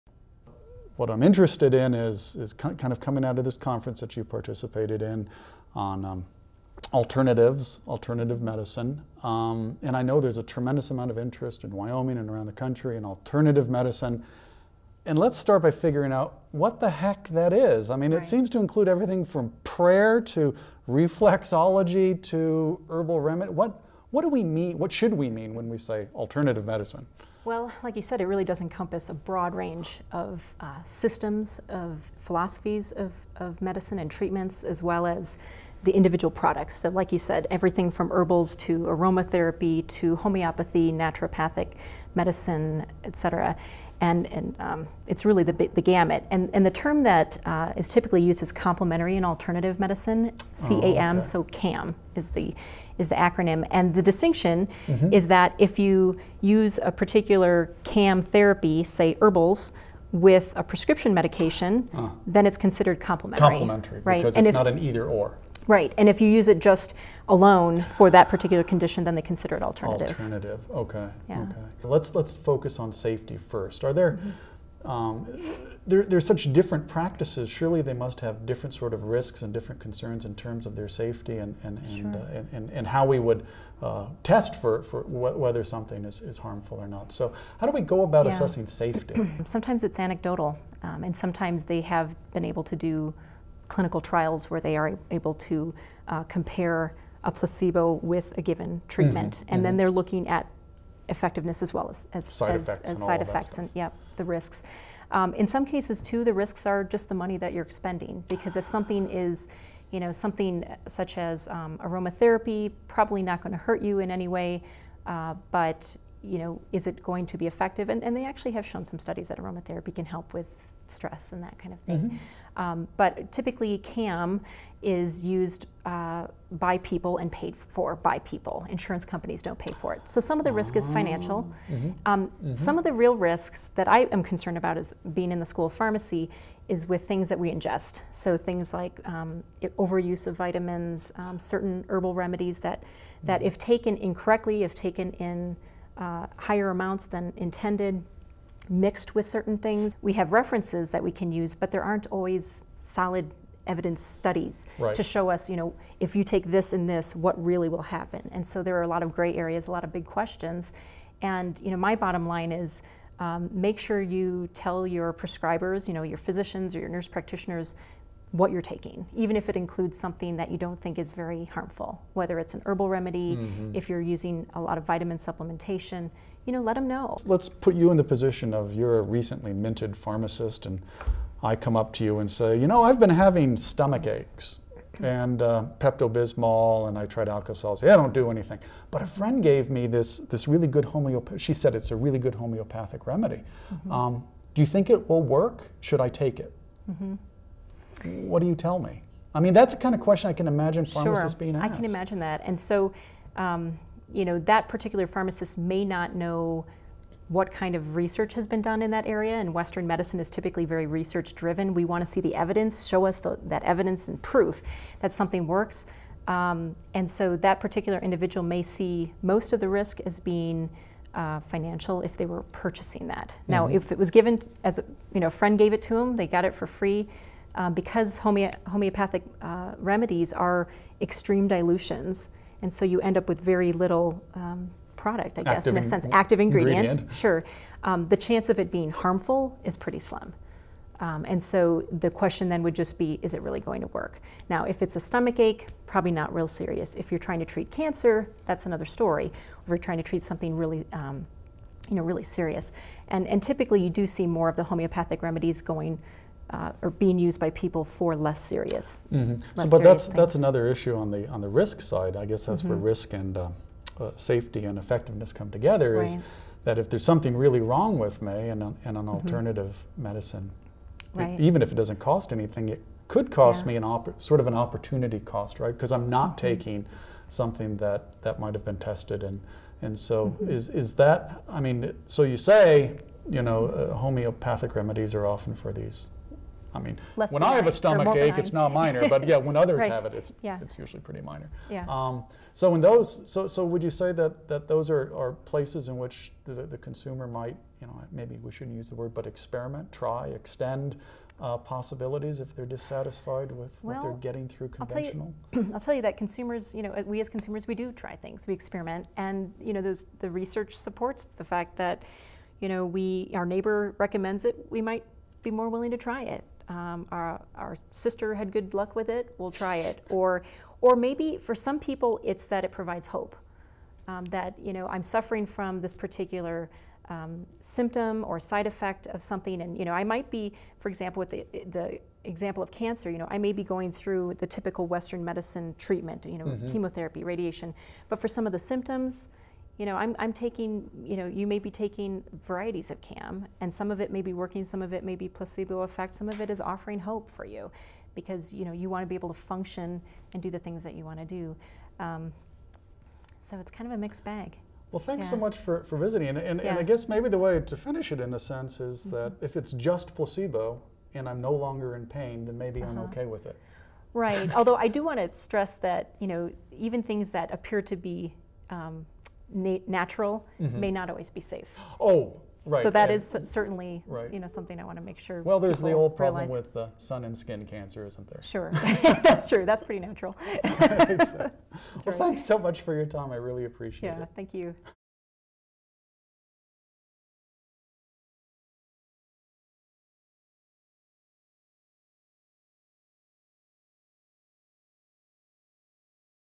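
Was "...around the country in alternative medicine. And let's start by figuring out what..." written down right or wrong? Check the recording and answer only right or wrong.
right.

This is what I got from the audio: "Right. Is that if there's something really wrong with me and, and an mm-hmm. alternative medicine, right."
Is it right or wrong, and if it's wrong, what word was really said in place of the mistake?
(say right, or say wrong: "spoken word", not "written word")
right.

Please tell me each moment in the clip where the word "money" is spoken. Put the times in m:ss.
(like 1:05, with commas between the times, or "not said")
1:47.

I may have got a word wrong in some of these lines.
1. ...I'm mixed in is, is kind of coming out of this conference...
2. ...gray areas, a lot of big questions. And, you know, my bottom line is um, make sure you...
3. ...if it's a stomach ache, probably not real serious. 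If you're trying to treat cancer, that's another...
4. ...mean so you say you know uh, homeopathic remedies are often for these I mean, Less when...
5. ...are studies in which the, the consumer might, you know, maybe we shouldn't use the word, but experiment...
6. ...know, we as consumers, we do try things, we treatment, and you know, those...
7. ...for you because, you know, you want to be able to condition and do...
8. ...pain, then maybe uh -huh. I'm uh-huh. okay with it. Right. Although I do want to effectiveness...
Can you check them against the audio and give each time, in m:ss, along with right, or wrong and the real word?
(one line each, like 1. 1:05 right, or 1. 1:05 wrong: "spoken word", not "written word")
1. 0:01 wrong: "interested", not "mixed"
2. 2:39 right
3. 4:04 right
4. 4:41 right
5. 4:55 wrong: "places", not "studies"
6. 5:06 wrong: "experiment", not "treatment"
7. 5:47 wrong: "function", not "condition"
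8. 6:02 wrong: "stress", not "effectiveness".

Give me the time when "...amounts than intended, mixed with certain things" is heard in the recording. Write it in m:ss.
2:26.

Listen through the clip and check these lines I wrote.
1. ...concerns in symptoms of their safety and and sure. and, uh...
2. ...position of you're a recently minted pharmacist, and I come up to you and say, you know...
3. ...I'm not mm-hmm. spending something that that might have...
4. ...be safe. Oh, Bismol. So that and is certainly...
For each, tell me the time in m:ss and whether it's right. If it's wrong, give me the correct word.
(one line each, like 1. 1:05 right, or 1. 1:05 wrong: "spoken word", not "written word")
1. 1:19 wrong: "terms", not "symptoms"
2. 2:58 right
3. 4:35 wrong: "taking", not "spending"
4. 6:11 wrong: "Right", not "Bismol".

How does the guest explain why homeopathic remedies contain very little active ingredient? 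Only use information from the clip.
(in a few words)
extreme dilutions.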